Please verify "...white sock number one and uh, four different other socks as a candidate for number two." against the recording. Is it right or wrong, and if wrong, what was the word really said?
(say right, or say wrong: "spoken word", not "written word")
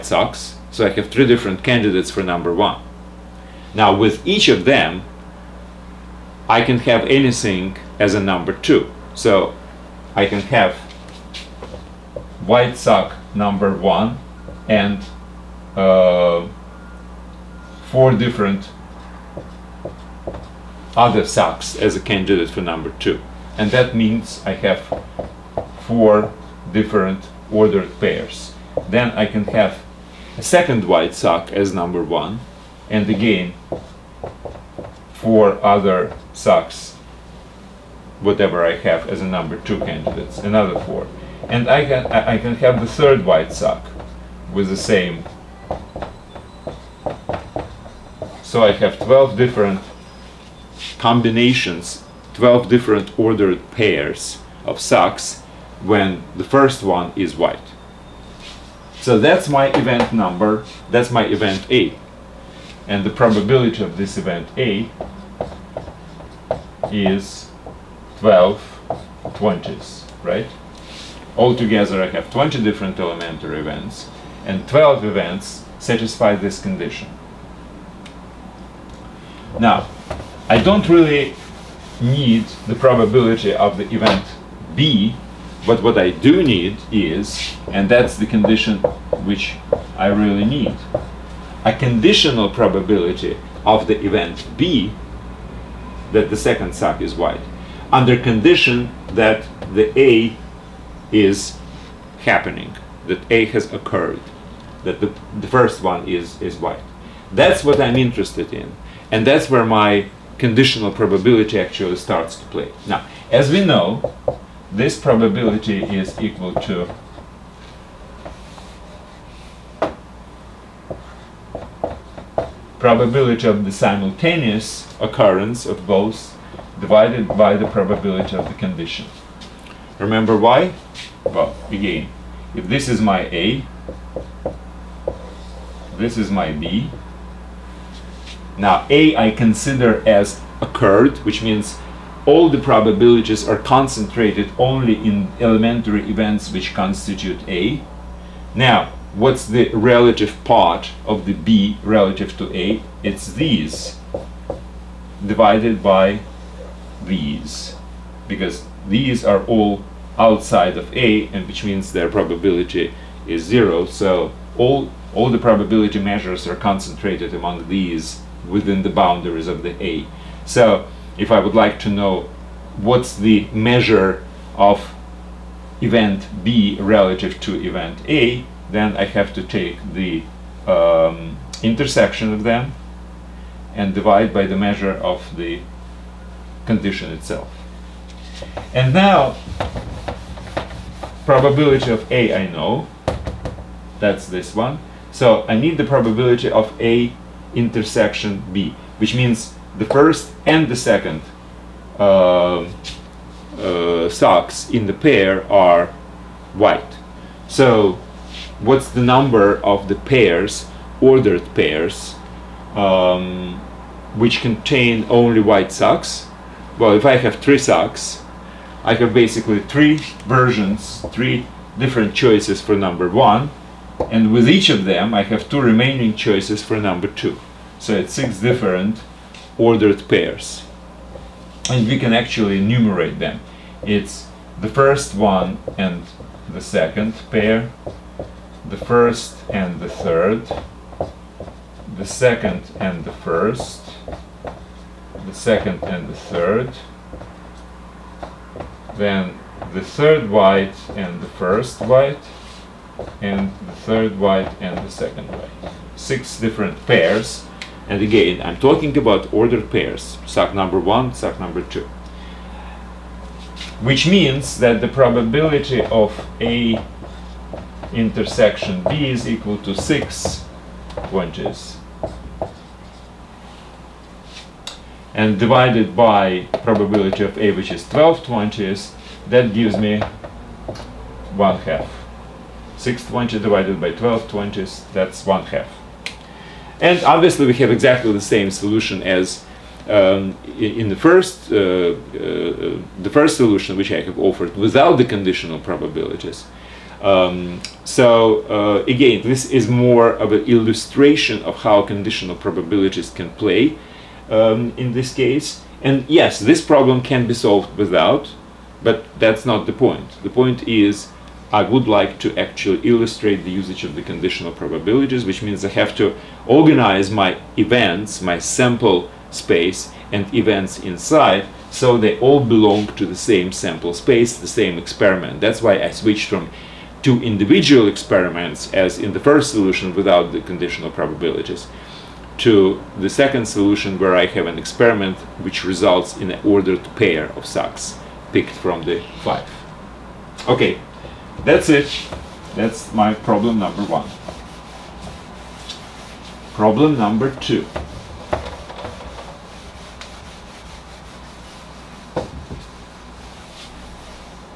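right.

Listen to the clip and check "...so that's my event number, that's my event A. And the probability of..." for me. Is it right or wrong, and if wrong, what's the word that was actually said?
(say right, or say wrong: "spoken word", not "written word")
right.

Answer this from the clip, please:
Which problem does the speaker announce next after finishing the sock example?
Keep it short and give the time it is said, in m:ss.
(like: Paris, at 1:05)
Problem number two, at 5:46.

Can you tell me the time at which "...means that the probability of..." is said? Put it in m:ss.
4:24.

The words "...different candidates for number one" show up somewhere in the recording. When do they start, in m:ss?
0:01.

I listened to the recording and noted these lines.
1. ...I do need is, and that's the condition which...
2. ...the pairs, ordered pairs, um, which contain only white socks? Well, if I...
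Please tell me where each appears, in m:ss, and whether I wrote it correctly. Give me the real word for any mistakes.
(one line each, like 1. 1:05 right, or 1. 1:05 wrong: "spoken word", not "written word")
1. 1:25 right
2. 3:29 right.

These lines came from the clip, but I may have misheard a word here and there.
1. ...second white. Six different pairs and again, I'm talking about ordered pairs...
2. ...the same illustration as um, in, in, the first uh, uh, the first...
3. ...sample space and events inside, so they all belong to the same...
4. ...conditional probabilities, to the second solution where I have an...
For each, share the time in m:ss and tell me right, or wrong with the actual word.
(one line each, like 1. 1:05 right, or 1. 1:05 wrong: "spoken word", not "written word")
1. 4:14 right
2. 4:48 wrong: "solution", not "illustration"
3. 5:18 right
4. 5:30 right.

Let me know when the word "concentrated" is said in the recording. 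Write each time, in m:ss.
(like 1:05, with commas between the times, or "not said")
2:23, 2:46.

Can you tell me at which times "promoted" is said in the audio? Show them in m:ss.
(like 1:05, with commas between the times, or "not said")
not said.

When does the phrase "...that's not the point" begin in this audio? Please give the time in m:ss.
5:09.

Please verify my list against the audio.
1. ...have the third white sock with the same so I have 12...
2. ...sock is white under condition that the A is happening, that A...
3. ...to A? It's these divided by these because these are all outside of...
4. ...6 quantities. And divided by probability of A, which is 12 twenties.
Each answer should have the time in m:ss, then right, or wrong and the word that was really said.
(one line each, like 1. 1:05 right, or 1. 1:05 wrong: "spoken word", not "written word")
1. 0:42 right
2. 1:36 right
3. 2:32 right
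4. 4:29 right.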